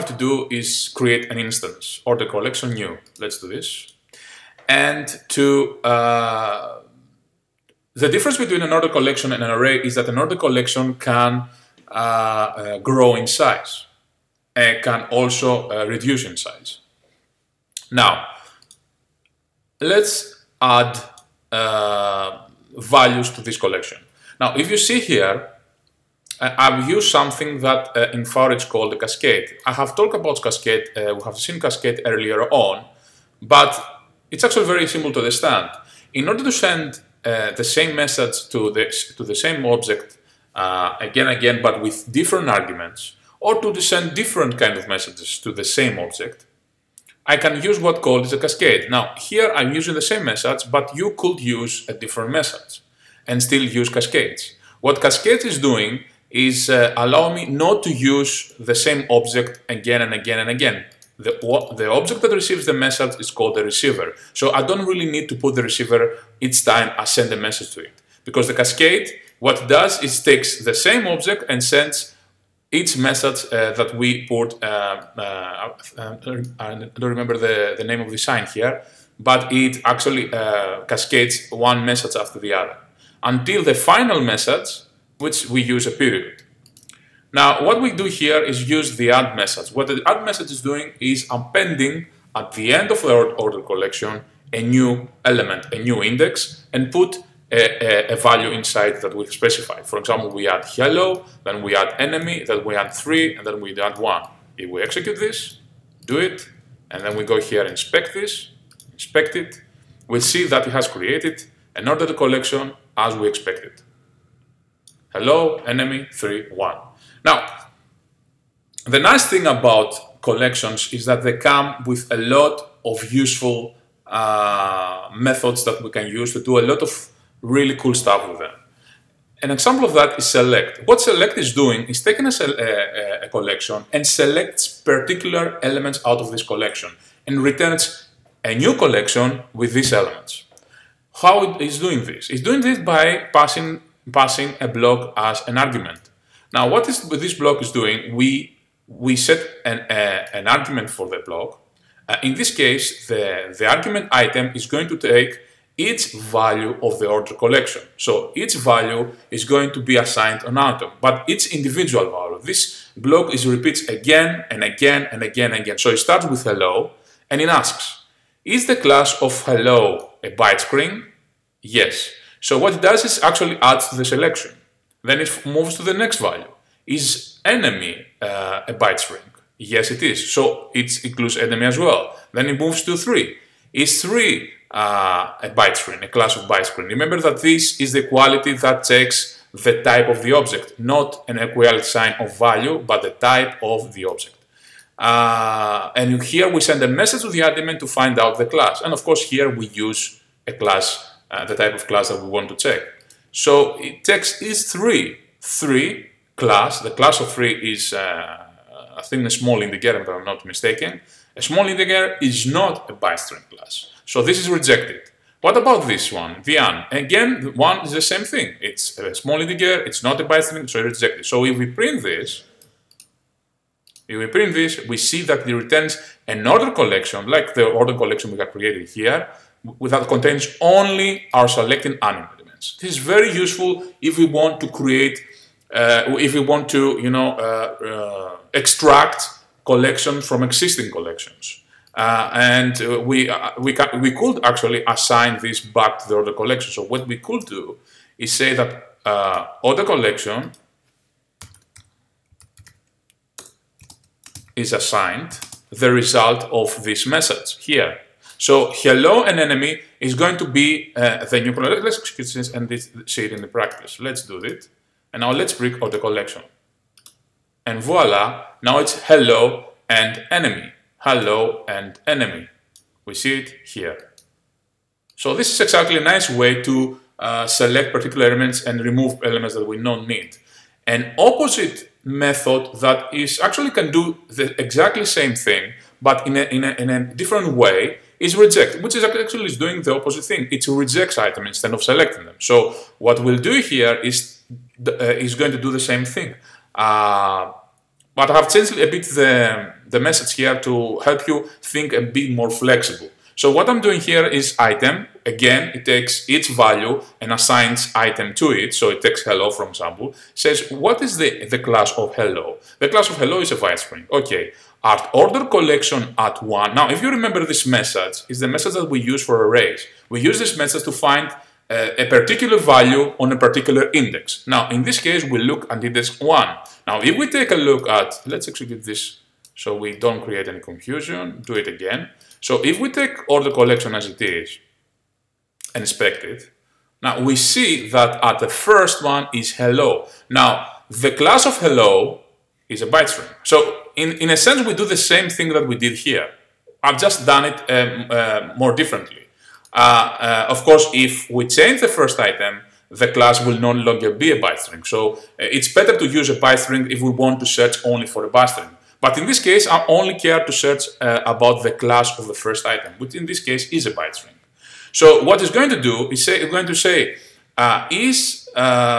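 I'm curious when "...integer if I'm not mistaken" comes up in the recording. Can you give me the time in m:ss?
3:29.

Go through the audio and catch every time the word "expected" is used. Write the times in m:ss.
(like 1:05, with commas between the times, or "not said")
1:53.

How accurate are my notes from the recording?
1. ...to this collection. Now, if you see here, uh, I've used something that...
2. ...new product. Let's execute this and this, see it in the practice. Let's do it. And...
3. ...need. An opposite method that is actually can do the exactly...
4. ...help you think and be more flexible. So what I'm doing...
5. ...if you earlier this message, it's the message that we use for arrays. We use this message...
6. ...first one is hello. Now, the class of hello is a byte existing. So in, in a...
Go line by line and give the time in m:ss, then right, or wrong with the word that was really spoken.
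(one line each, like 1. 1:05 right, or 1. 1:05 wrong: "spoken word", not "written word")
1. 0:23 right
2. 4:21 right
3. 4:40 right
4. 5:00 right
5. 5:16 wrong: "remember", not "earlier"
6. 5:38 wrong: "string", not "existing".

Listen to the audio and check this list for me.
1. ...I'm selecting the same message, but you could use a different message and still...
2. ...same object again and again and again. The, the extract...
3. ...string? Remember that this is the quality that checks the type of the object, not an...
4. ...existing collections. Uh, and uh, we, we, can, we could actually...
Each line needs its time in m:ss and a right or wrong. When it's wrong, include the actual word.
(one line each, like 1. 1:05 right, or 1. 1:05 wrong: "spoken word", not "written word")
1. 0:49 wrong: "using", not "selecting"
2. 0:58 wrong: "object", not "extract"
3. 3:06 right
4. 4:00 right.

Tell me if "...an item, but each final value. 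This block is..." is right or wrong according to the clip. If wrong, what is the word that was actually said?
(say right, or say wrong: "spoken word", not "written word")
wrong: "individual", not "final".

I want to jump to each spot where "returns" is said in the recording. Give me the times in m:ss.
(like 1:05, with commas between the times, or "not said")
2:17, 3:45.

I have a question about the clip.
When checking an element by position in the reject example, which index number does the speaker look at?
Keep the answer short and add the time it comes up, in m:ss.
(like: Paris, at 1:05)
1, at 5:25.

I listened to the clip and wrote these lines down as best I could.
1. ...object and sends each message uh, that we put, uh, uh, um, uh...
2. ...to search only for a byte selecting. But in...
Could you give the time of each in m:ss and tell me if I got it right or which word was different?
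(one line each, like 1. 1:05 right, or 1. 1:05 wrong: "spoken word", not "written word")
1. 1:11 right
2. 5:57 wrong: "string", not "selecting".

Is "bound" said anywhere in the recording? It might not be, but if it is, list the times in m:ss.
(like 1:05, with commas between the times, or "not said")
not said.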